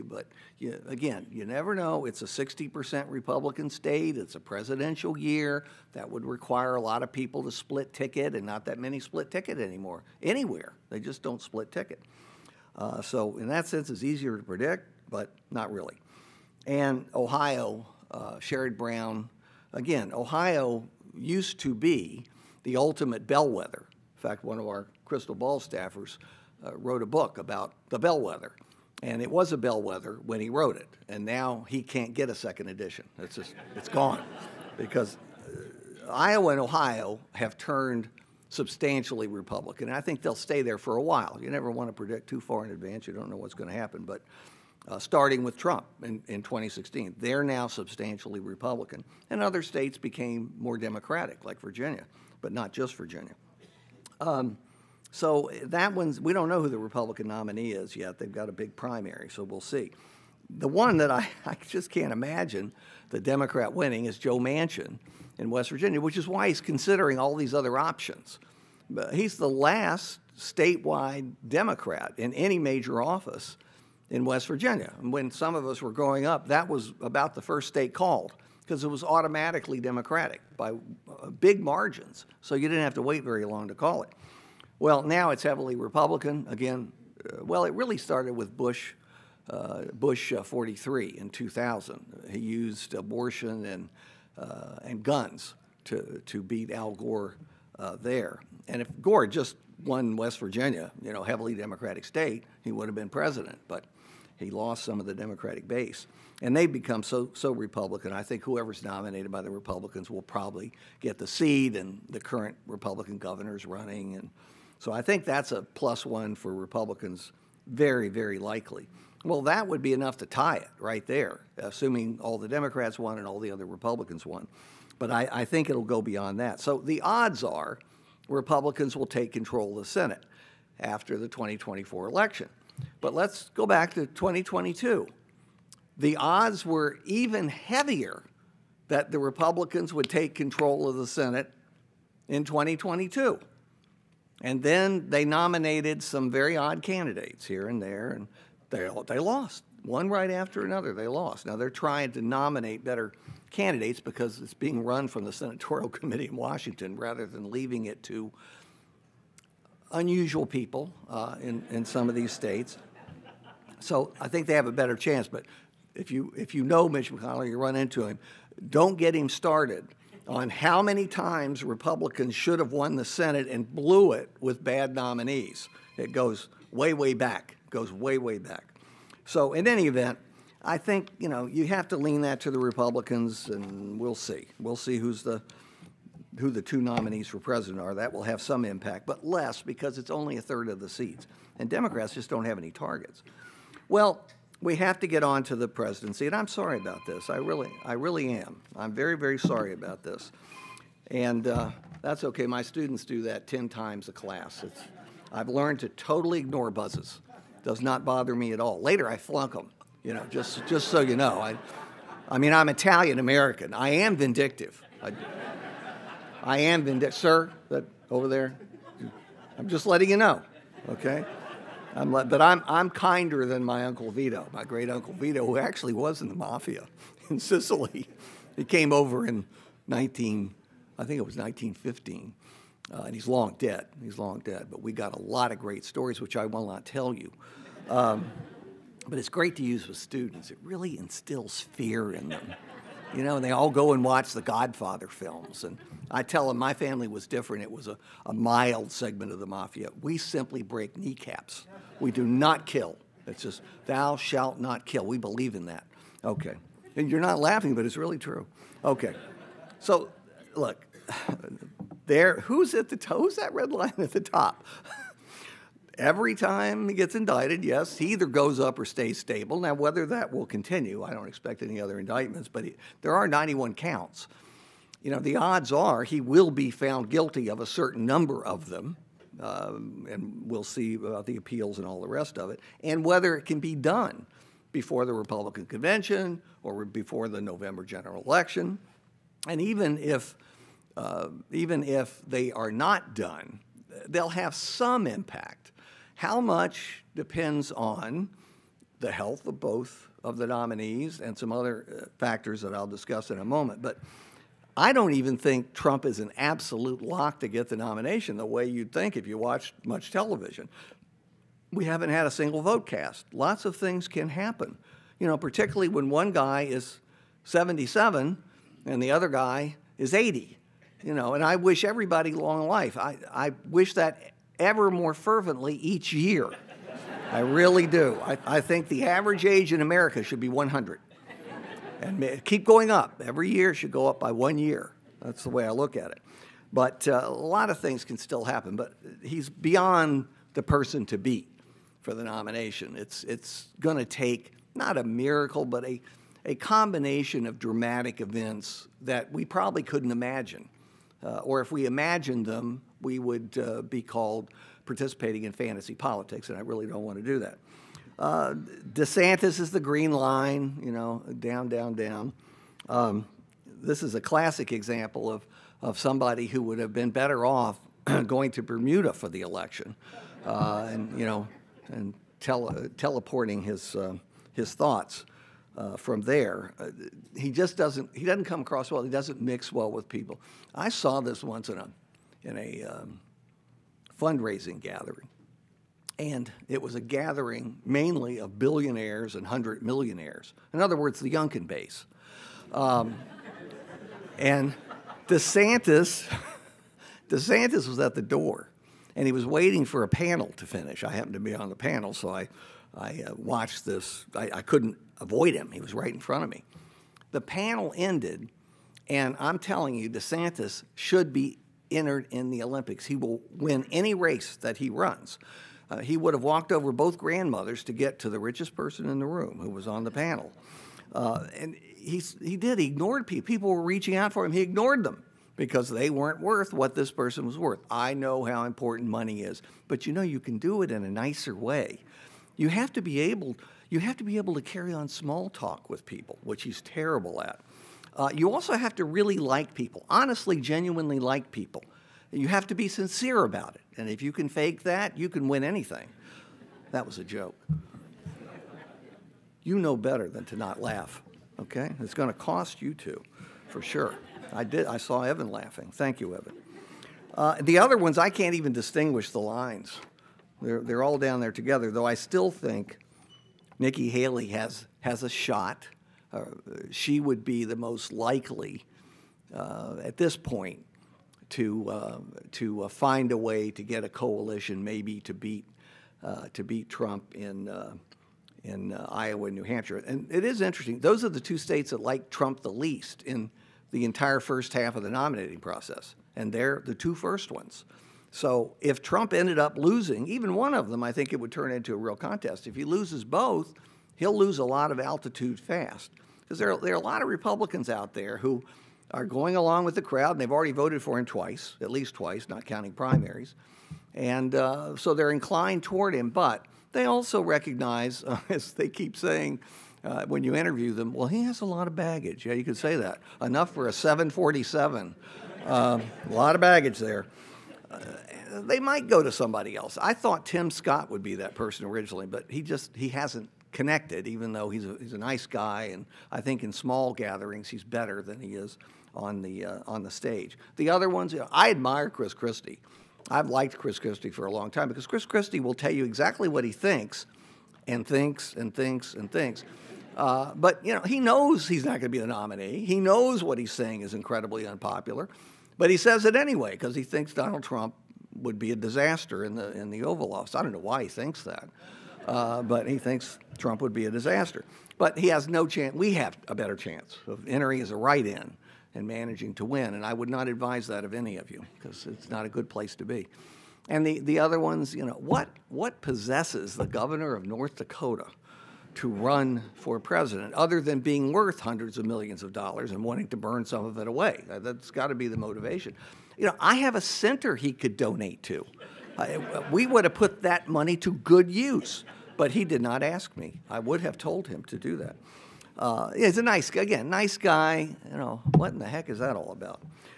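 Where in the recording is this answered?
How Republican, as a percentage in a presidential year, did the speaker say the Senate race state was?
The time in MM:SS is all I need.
00:02.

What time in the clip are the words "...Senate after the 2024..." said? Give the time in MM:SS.
02:09.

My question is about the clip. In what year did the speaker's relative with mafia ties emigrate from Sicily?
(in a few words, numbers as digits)
1915.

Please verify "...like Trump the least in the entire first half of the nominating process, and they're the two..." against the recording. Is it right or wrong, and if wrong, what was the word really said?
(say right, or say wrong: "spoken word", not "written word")
right.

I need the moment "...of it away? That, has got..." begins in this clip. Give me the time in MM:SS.
09:33.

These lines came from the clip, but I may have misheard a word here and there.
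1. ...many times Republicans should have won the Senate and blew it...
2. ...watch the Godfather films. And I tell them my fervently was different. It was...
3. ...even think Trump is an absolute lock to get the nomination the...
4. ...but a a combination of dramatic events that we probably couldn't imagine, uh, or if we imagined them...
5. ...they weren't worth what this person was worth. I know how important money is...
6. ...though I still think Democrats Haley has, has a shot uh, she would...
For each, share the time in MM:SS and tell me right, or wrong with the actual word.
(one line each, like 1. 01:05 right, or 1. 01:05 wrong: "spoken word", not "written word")
1. 02:50 right
2. 04:04 wrong: "family", not "fervently"
3. 05:05 right
4. 05:45 right
5. 07:05 right
6. 07:41 wrong: "Nikki", not "Democrats".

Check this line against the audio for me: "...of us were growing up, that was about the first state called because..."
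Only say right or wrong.
right.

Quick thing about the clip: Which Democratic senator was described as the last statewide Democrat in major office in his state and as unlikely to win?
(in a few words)
Joe Manchin.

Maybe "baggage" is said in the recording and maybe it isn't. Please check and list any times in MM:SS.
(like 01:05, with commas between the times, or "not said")
08:31, 08:36.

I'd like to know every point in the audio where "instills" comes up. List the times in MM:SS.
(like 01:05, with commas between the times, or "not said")
04:00.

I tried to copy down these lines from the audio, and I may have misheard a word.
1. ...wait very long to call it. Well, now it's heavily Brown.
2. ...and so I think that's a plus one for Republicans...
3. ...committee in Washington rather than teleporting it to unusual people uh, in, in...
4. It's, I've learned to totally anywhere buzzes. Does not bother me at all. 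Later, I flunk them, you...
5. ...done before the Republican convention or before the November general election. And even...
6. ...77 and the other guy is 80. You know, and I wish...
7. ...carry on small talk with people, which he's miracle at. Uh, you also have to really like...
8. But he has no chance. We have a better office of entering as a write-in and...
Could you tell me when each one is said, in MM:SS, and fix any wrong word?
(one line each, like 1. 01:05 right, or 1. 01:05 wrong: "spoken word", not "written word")
1. 01:23 wrong: "Republican", not "Brown"
2. 01:54 right
3. 02:35 wrong: "leaving", not "teleporting"
4. 03:24 wrong: "ignore", not "anywhere"
5. 04:43 right
6. 05:17 right
7. 07:14 wrong: "terrible", not "miracle"
8. 09:14 wrong: "chance", not "office".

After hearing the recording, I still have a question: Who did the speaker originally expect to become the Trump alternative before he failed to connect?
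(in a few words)
Tim Scott.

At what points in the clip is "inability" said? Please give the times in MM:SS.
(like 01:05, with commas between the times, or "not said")
not said.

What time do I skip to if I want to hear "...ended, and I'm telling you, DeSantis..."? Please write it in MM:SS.
06:47.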